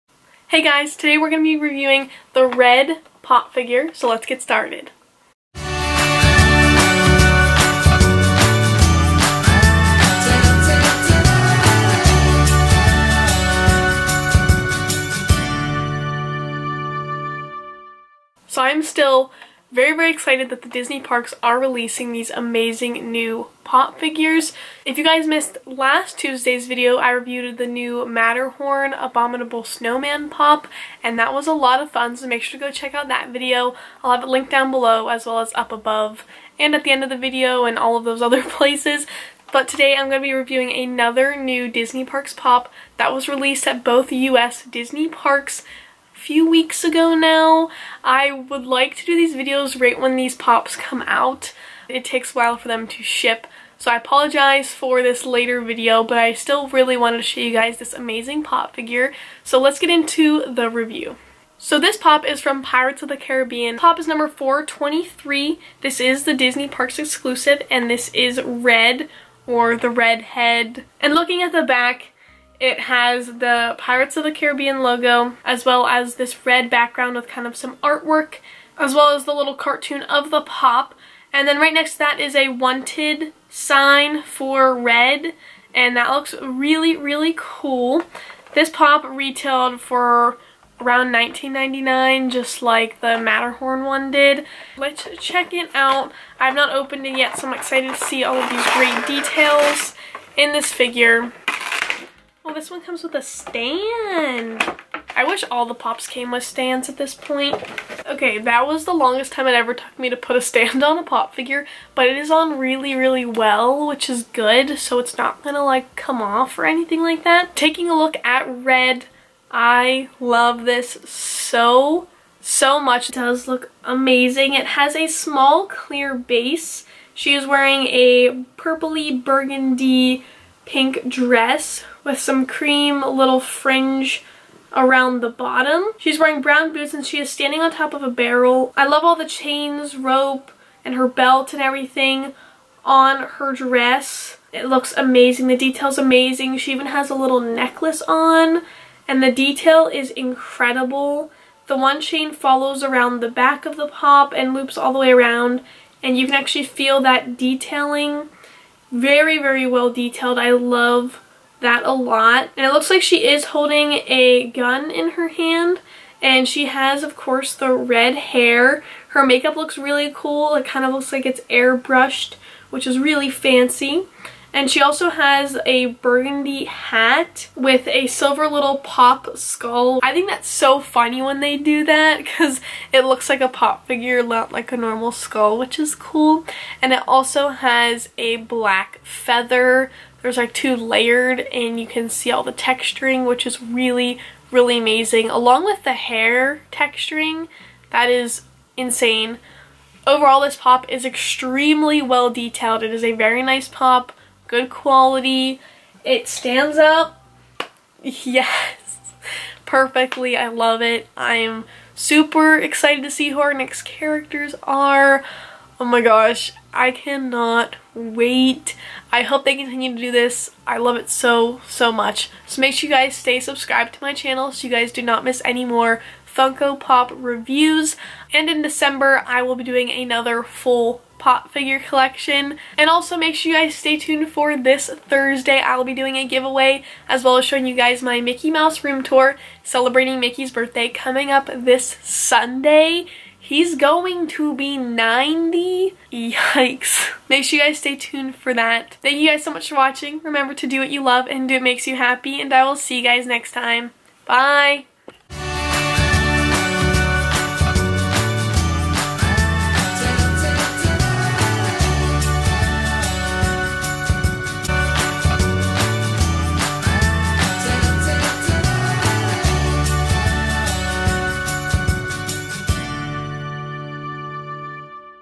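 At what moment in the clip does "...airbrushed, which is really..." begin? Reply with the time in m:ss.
2:51.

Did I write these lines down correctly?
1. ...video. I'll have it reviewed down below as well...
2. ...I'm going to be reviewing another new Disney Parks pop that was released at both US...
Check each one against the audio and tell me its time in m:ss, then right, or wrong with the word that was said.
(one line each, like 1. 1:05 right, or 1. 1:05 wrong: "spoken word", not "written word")
1. 0:33 wrong: "linked", not "reviewed"
2. 0:39 right.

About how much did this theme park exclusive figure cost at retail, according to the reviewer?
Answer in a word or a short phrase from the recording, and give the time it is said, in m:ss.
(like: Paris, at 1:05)
$19.99, at 1:31.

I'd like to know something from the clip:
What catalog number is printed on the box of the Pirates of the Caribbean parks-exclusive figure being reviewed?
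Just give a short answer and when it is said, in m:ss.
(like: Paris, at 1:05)
423, at 1:04.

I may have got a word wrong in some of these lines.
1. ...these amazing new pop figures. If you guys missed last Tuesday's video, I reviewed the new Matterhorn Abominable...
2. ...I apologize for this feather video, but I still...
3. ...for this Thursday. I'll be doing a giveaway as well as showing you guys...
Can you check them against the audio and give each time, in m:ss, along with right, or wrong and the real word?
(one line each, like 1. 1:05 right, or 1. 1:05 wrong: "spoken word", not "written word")
1. 0:22 right
2. 0:53 wrong: "later", not "feather"
3. 3:54 right.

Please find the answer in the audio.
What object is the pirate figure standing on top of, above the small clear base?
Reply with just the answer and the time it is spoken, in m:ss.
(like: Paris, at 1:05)
A barrel, at 2:18.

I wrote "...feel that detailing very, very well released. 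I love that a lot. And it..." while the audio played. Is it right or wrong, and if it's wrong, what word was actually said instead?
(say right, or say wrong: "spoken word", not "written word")
wrong: "detailed", not "released".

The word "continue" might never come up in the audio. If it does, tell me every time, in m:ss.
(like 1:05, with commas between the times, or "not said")
3:39.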